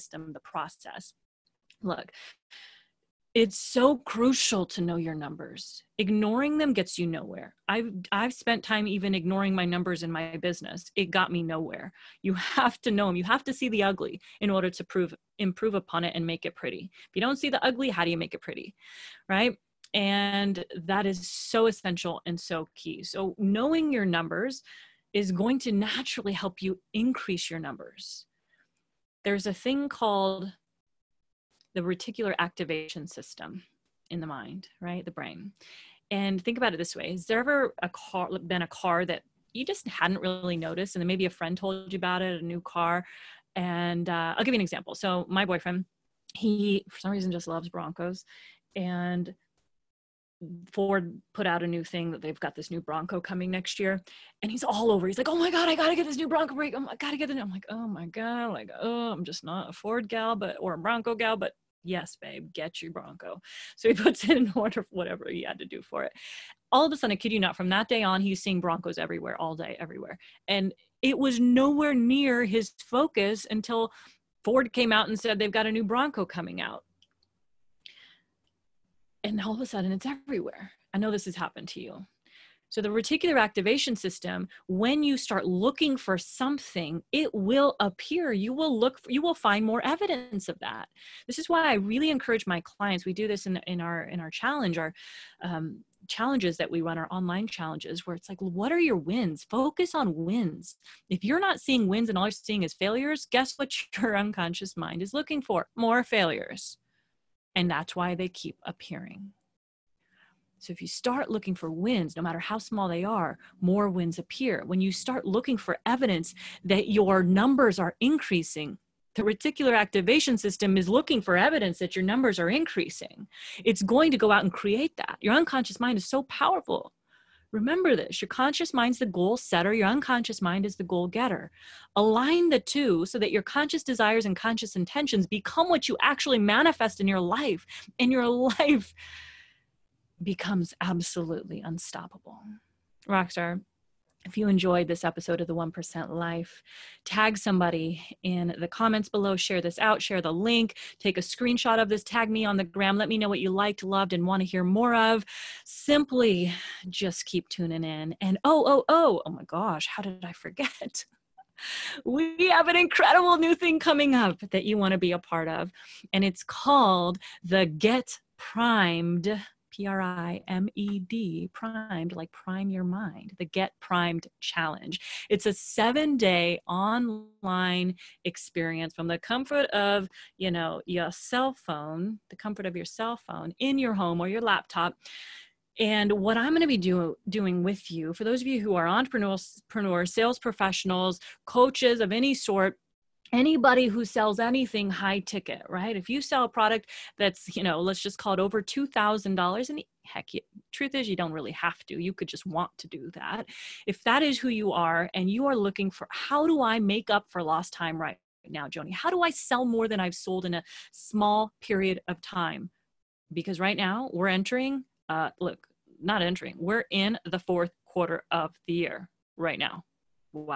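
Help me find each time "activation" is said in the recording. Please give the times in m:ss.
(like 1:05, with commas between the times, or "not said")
0:32, 1:23, 1:59.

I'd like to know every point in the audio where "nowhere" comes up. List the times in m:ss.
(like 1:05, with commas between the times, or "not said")
0:07, 0:11, 1:11.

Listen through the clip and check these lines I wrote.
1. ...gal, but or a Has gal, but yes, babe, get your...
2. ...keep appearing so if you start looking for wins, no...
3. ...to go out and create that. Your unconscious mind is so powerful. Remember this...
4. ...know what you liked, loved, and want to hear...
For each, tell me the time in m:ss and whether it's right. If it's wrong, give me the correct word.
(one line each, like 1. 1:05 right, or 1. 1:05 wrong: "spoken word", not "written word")
1. 1:00 wrong: "Bronco", not "Has"
2. 1:48 right
3. 2:04 right
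4. 2:33 right.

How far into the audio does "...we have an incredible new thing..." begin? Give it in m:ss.
2:42.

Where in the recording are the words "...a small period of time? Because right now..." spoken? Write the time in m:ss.
3:30.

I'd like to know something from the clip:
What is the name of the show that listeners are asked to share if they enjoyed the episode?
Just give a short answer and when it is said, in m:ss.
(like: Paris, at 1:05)
The 1% Life, at 2:25.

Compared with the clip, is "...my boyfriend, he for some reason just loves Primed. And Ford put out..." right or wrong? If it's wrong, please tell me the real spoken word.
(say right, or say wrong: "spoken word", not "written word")
wrong: "Broncos", not "Primed".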